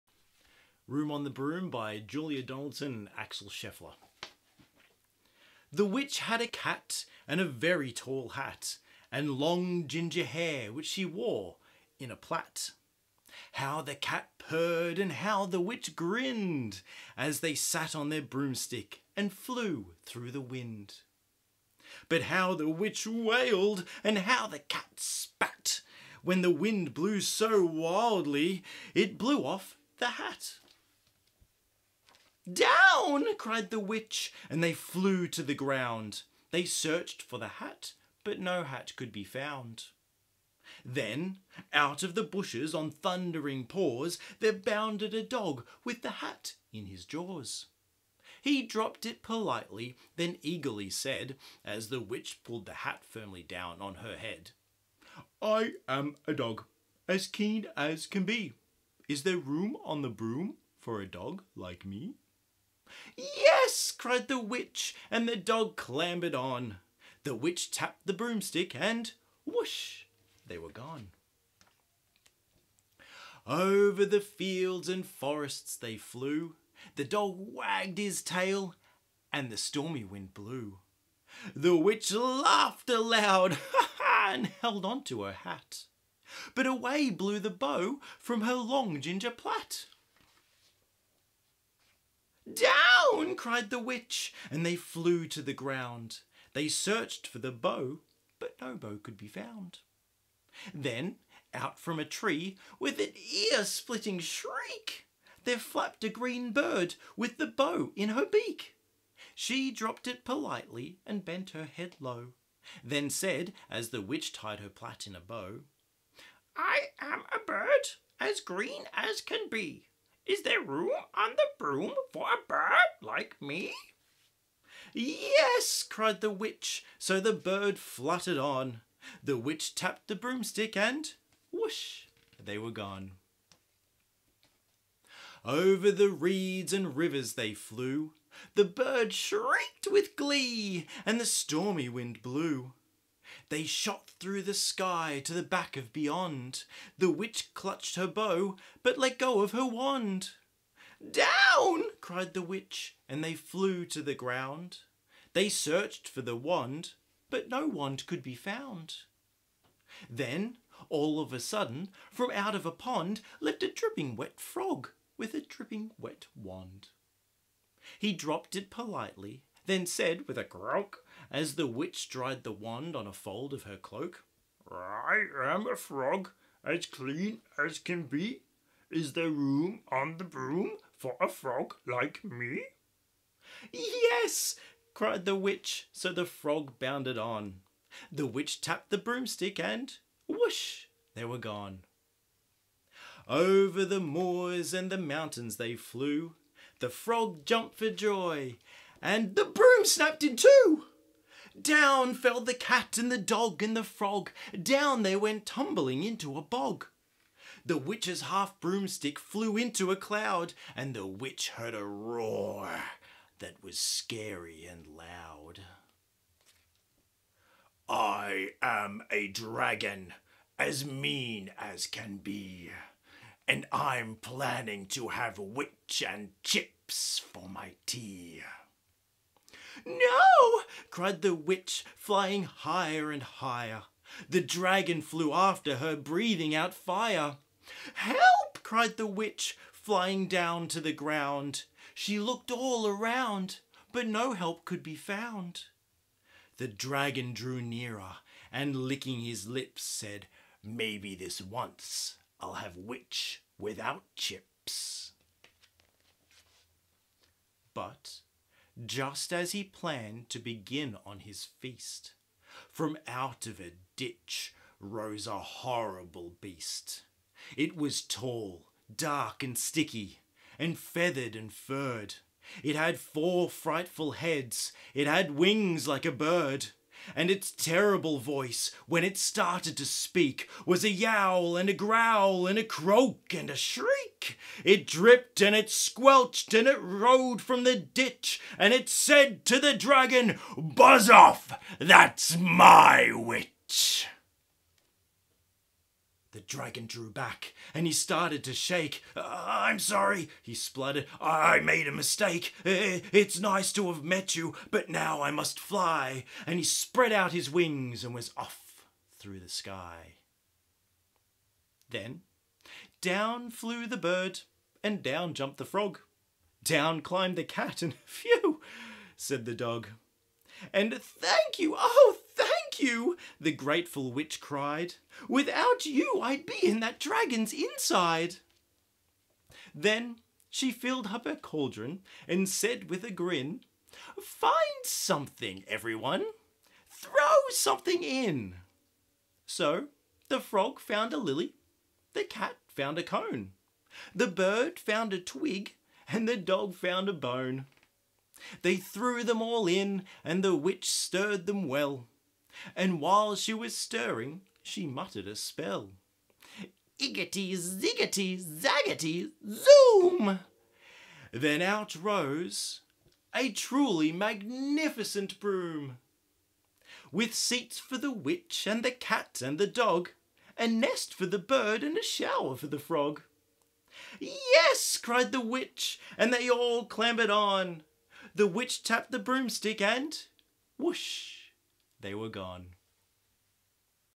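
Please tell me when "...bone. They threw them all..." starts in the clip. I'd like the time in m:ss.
5:47.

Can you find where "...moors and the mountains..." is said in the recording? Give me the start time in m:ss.
3:13.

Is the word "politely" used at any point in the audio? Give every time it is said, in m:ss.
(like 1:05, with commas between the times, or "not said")
0:49, 1:50, 2:48.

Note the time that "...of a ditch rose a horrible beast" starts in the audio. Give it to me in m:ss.
4:23.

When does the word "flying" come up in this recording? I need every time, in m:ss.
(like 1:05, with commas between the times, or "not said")
3:51, 3:59.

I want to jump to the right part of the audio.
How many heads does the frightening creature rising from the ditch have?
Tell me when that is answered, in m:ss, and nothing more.
4:32.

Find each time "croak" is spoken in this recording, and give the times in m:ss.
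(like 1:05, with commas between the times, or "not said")
2:50, 4:42.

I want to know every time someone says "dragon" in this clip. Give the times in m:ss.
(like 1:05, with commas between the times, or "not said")
3:39, 3:54, 4:06, 4:49, 4:56, 5:26.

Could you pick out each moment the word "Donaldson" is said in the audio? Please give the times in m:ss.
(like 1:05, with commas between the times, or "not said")
0:02.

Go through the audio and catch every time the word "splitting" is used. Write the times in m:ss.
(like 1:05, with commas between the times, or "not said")
1:43.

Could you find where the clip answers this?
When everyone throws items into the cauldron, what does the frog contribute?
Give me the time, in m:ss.
5:41.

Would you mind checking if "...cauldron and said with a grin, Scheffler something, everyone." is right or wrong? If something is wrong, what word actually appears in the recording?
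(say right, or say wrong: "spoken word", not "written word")
wrong: "Find", not "Scheffler".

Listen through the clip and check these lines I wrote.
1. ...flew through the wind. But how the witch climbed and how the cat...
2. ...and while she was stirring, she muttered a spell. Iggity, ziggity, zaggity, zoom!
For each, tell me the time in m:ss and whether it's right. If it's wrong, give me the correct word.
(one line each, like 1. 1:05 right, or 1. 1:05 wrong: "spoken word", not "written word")
1. 0:19 wrong: "wailed", not "climbed"
2. 5:52 right.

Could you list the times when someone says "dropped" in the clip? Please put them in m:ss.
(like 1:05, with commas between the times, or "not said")
0:48, 1:49, 2:48.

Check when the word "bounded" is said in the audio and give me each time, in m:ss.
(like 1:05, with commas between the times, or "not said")
0:44, 3:06.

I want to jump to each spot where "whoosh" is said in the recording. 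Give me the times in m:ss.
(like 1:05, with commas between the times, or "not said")
1:09, 2:11, 3:10, 6:20.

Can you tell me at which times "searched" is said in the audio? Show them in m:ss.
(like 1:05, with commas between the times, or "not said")
0:36, 1:36, 2:35.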